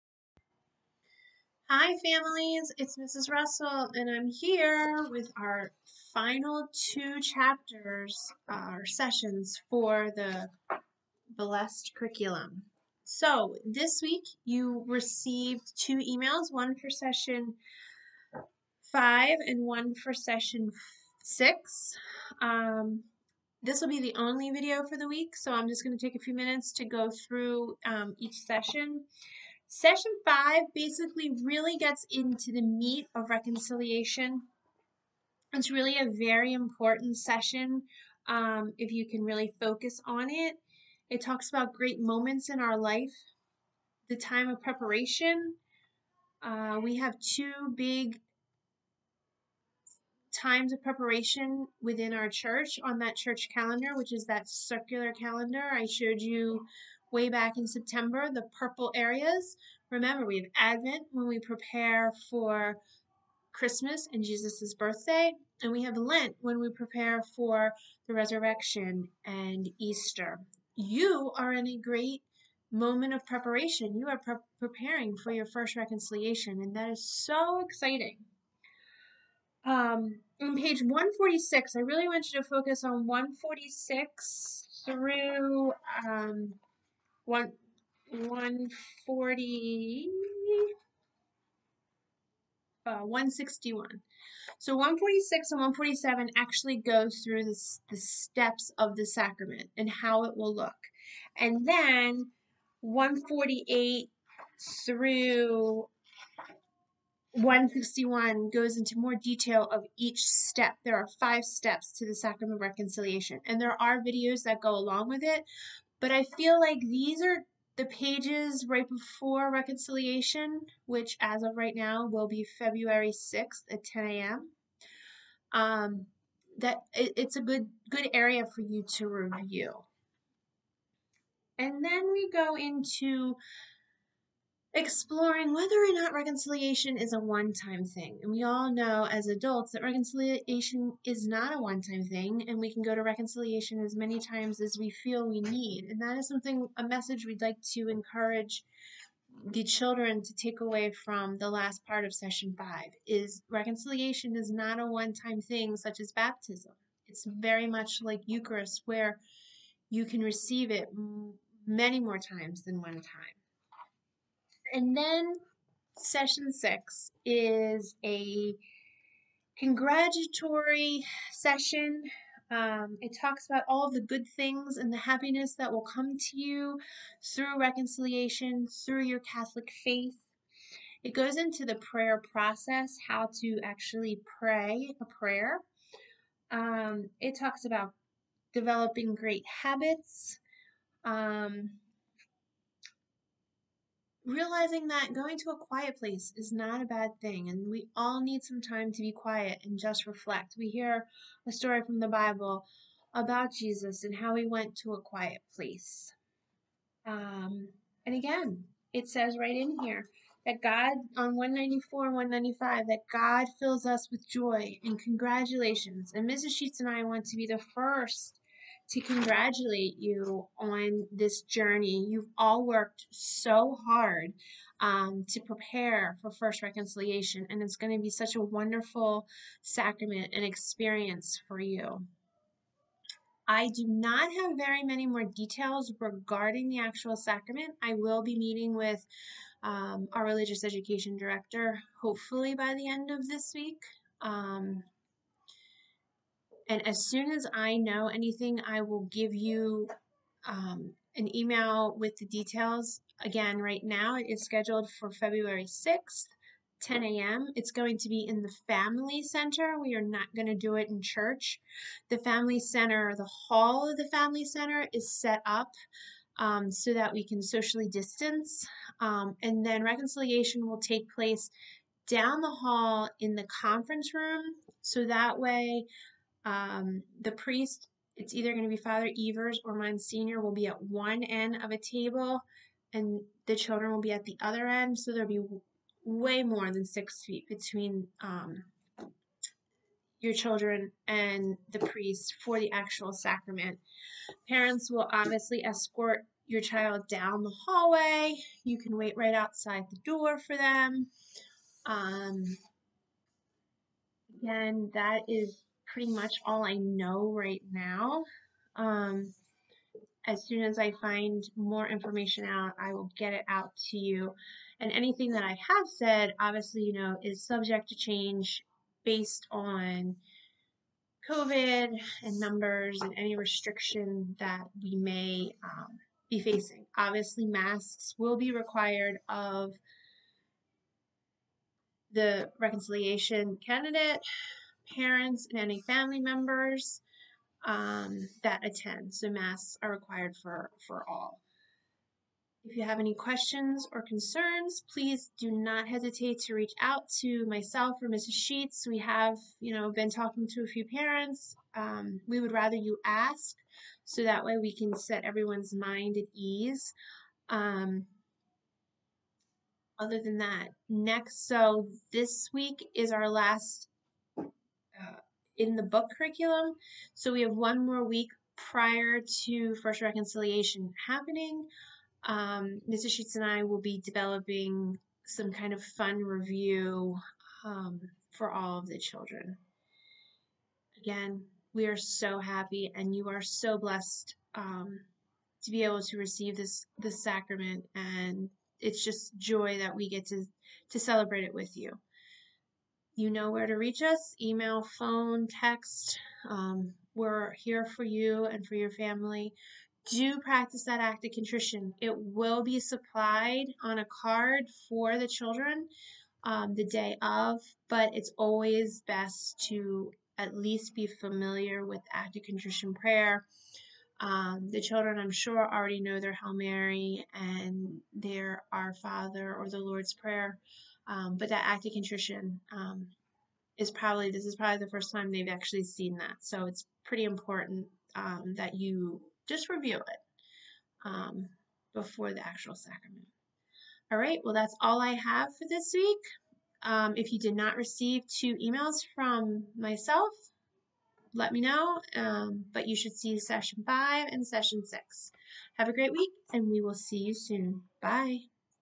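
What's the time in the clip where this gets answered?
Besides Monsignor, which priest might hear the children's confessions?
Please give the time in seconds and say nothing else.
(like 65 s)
278 s.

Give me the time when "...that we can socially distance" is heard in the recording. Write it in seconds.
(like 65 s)
266 s.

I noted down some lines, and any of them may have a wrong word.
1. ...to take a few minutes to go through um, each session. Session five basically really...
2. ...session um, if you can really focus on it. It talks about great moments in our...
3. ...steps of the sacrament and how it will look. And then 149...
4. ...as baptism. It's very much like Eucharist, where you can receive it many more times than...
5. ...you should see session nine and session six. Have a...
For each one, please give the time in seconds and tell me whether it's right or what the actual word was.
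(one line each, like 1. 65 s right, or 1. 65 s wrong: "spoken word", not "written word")
1. 25 s right
2. 37 s right
3. 97 s wrong: "148", not "149"
4. 155 s right
5. 442 s wrong: "five", not "nine".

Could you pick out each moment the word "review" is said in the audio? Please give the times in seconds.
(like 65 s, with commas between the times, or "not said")
129 s, 376 s, 429 s.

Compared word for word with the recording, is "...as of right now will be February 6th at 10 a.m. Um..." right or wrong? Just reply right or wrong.
right.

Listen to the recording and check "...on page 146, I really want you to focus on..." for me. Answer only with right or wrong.
right.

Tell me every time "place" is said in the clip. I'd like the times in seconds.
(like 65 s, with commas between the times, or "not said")
195 s, 205 s, 271 s.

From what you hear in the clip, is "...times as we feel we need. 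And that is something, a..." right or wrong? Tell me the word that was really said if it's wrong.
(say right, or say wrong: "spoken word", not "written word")
right.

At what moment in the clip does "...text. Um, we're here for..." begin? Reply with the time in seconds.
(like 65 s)
395 s.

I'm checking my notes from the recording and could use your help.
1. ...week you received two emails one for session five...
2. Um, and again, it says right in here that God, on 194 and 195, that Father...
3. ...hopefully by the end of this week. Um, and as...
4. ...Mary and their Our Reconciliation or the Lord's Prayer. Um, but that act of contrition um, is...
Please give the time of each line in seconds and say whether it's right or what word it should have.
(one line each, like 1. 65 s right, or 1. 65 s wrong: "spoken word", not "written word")
1. 14 s right
2. 207 s wrong: "God", not "Father"
3. 242 s right
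4. 416 s wrong: "Father", not "Reconciliation".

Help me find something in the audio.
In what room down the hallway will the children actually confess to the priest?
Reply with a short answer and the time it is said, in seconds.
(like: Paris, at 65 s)
conference room, at 273 s.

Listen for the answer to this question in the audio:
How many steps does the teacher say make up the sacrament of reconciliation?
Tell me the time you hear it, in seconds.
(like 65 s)
111 s.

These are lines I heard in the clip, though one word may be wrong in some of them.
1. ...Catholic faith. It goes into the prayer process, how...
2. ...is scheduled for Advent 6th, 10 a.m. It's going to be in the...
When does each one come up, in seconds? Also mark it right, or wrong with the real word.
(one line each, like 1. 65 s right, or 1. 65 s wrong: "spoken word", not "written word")
1. 179 s right
2. 254 s wrong: "February", not "Advent".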